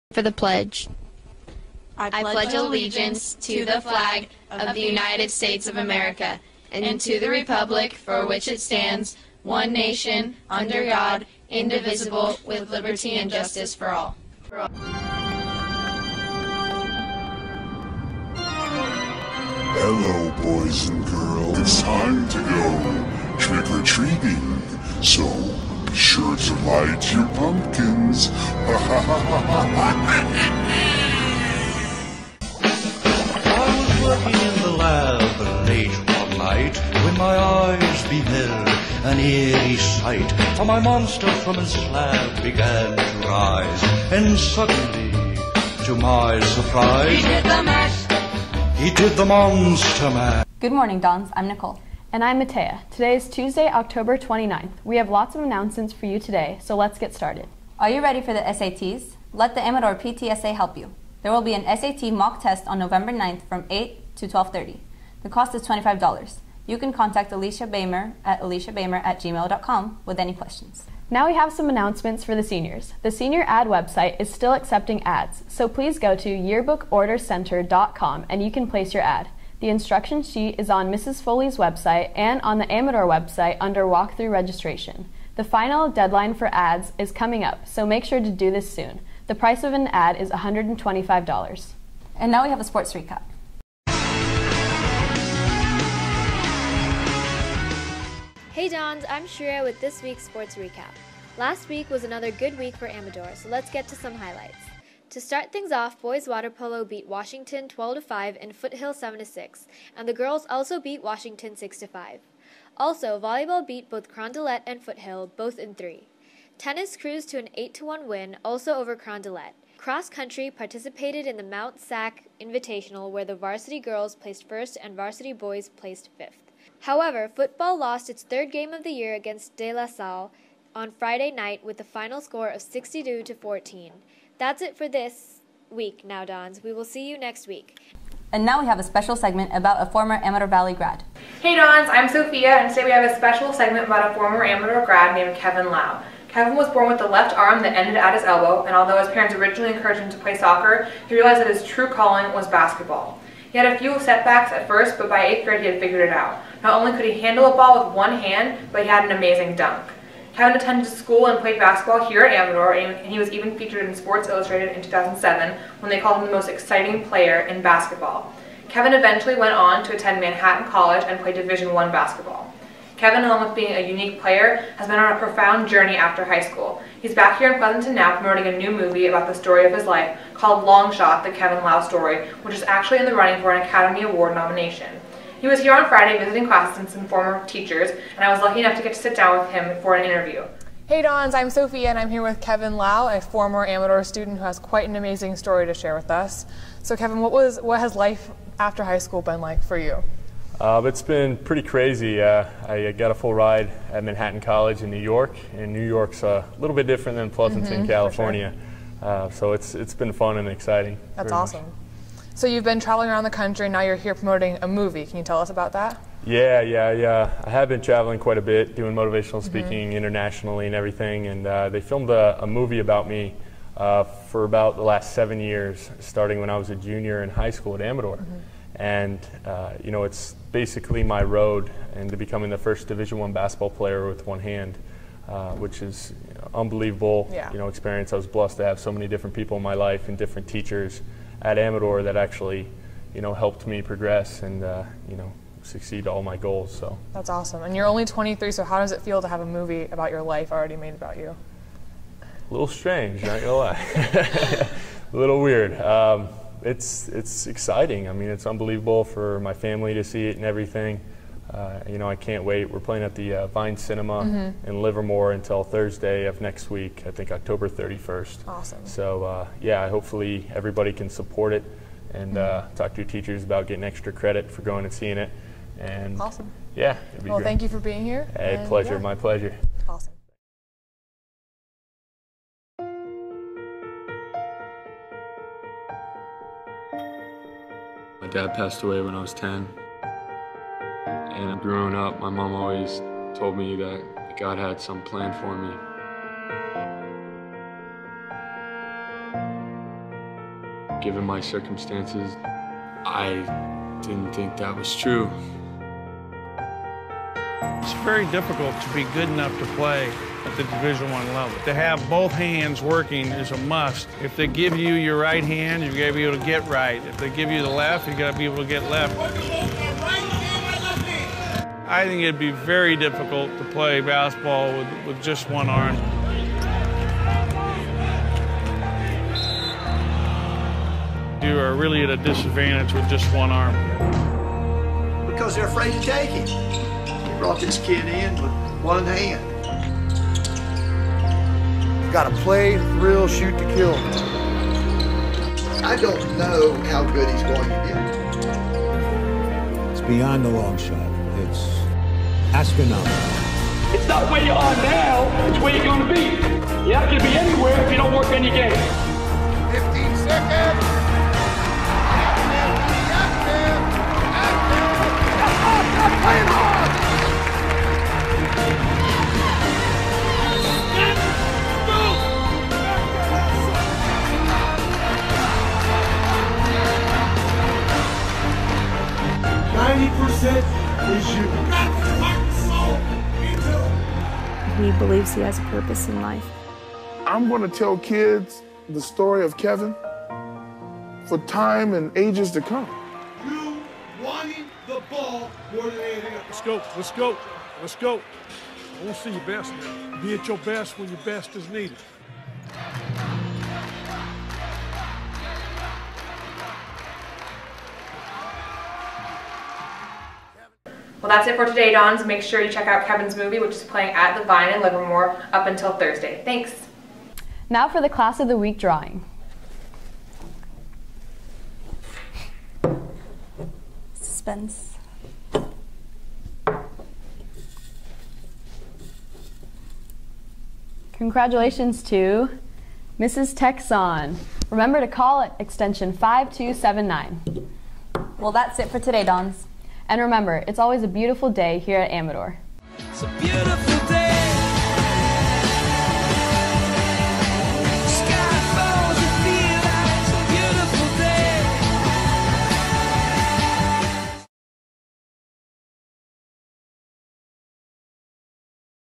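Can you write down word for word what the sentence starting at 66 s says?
You can contact Alicia Bamer at aliciabamer at gmail.com with any questions.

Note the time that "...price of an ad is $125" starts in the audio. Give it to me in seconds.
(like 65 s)
89 s.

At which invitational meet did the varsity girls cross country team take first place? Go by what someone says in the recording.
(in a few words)
Mount SAC Invitational.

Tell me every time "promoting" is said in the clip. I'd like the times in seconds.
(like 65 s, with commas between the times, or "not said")
178 s, 214 s.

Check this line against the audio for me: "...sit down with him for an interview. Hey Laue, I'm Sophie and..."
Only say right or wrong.
wrong.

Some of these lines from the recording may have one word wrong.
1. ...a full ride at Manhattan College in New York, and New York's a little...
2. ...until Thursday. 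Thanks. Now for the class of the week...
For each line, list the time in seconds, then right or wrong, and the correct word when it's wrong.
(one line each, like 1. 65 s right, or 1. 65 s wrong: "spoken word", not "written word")
1. 203 s right
2. 415 s right.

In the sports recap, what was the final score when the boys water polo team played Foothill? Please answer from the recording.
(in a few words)
7 to 6.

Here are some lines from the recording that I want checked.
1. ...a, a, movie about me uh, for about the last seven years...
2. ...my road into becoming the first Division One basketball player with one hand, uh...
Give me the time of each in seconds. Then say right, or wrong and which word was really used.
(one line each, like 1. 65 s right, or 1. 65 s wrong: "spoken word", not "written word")
1. 222 s right
2. 231 s right.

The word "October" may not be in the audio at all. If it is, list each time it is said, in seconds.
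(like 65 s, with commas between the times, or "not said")
53 s, 267 s.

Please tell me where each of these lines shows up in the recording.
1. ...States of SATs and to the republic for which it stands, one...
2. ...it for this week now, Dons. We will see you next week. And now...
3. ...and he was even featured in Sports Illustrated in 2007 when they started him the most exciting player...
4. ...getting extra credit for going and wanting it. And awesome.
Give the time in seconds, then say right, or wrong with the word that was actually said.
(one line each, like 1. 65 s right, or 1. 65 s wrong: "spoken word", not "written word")
1. 5 s wrong: "America", not "SATs"
2. 134 s right
3. 162 s wrong: "called", not "started"
4. 273 s wrong: "seeing", not "wanting".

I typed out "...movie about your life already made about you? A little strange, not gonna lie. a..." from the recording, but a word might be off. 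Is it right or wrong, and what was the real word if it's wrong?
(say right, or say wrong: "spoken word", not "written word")
right.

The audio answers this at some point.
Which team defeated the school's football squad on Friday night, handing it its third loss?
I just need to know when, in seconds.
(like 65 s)
129 s.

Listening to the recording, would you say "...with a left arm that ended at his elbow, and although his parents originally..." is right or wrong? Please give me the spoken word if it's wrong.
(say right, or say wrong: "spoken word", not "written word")
right.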